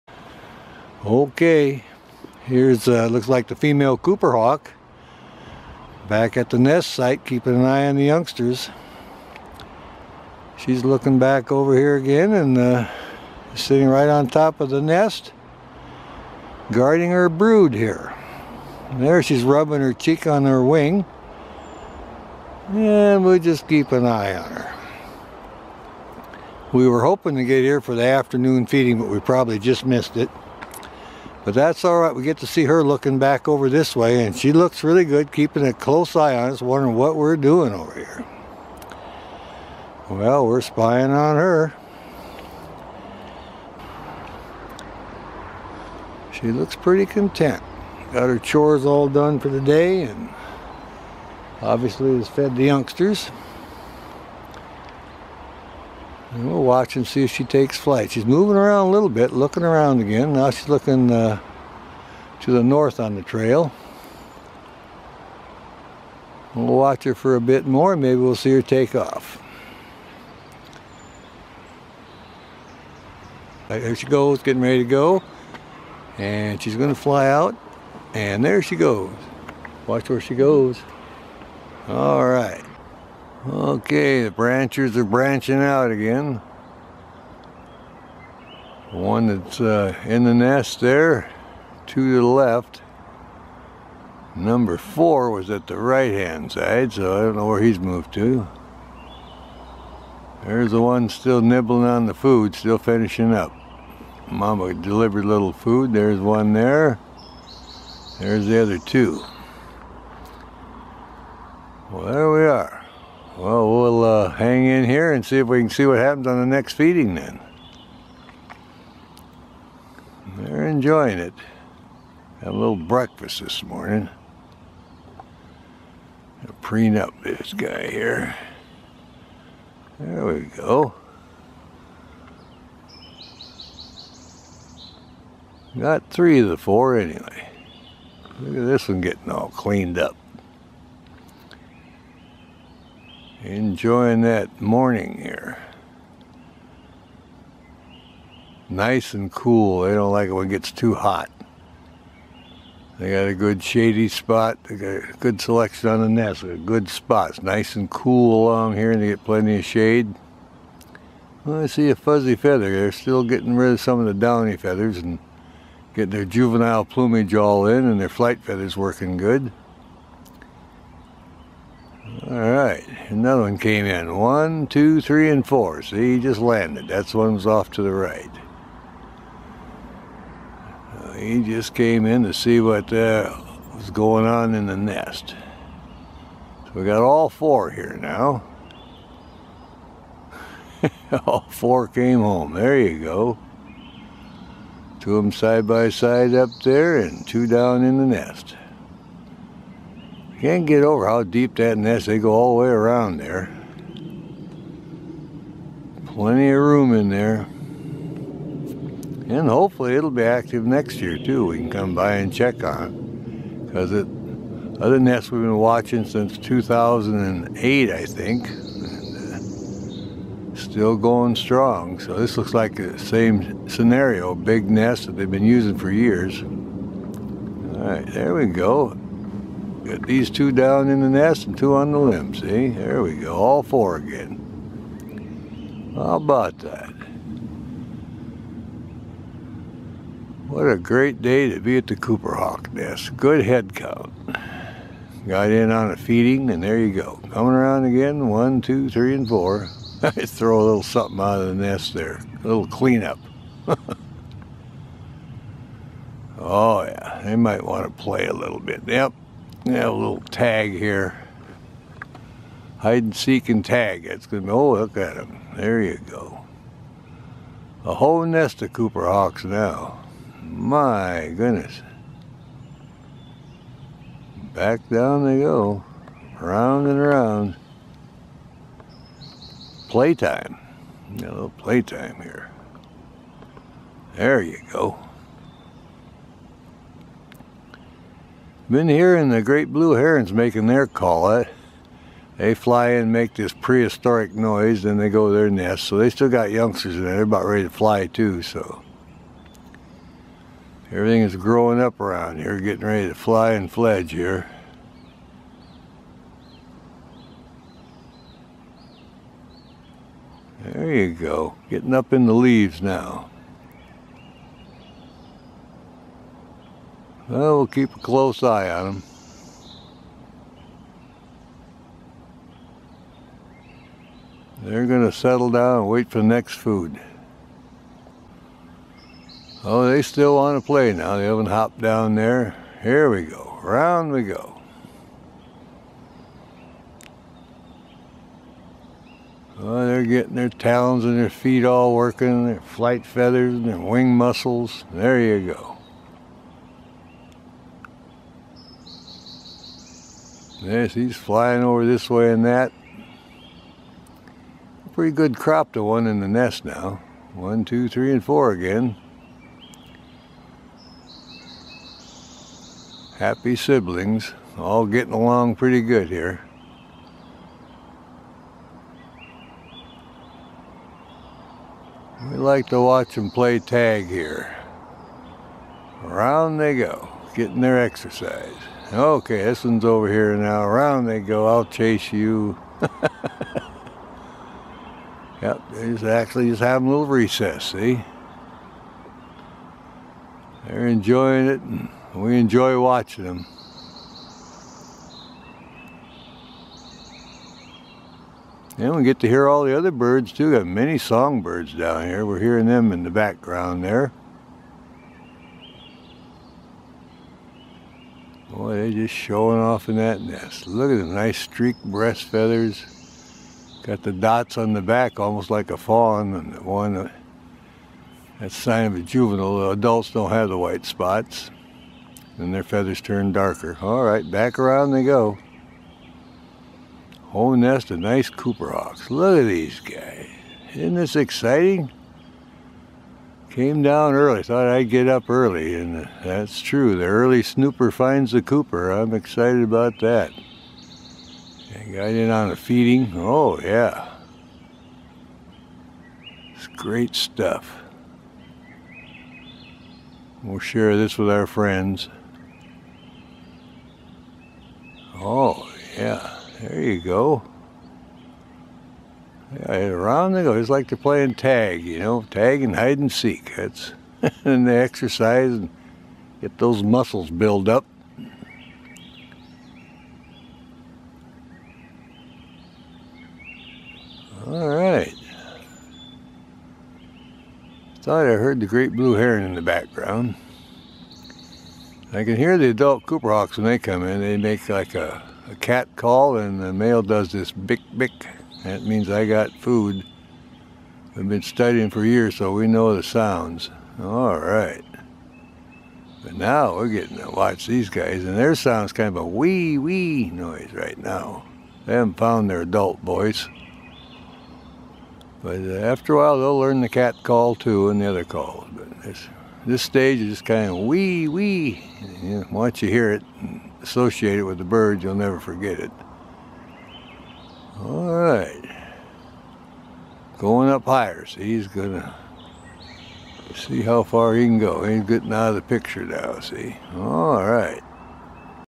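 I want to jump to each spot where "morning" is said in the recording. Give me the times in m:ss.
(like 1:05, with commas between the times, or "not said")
2:03, 2:24.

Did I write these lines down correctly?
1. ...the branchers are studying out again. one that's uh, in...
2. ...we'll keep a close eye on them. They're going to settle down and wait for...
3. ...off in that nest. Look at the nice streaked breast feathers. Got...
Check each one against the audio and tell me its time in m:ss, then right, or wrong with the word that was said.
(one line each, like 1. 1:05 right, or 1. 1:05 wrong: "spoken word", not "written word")
1. 1:24 wrong: "branching", not "studying"
2. 5:17 right
3. 6:49 right.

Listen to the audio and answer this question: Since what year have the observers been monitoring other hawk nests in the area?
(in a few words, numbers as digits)
2008.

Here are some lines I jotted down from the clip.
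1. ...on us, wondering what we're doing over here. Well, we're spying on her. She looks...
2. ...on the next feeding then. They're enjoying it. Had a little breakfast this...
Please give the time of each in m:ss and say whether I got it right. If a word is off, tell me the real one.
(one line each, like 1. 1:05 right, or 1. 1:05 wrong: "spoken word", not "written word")
1. 0:36 right
2. 1:56 right.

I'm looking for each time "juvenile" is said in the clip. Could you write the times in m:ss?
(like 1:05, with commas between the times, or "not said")
2:46, 6:58.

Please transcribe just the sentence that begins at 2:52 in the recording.
All right, another one came in.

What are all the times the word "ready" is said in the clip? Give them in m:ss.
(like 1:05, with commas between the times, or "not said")
1:14, 4:57, 5:02.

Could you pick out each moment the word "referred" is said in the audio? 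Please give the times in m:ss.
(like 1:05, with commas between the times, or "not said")
not said.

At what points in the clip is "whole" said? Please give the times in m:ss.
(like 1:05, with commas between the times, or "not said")
4:27, 7:07.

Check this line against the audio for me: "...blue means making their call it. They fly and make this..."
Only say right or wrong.
wrong.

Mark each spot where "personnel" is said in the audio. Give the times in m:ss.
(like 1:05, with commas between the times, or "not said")
not said.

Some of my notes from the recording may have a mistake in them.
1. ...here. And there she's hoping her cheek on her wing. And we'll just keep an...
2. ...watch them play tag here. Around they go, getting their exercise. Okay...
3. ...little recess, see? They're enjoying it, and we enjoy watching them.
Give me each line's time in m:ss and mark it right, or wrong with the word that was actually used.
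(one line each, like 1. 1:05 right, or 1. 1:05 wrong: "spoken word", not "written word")
1. 0:17 wrong: "rubbing", not "hoping"
2. 6:12 right
3. 6:26 right.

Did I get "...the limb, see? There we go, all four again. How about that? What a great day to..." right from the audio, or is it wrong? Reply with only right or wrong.
right.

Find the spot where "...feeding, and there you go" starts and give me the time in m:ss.
4:05.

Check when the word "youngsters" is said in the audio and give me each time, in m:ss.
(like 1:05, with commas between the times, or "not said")
0:08, 0:52, 4:56.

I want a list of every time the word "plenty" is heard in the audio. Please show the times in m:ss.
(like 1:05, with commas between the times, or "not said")
2:39, 3:26.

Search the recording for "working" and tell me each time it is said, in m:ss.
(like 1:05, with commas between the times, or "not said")
2:48, 5:41.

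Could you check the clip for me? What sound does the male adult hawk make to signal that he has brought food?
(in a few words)
bick bick.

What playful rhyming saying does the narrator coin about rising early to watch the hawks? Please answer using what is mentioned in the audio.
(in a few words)
The early snooper finds the cooper.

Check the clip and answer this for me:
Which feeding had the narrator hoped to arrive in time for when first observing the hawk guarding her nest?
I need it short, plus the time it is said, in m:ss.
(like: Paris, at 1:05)
afternoon feeding, at 0:28.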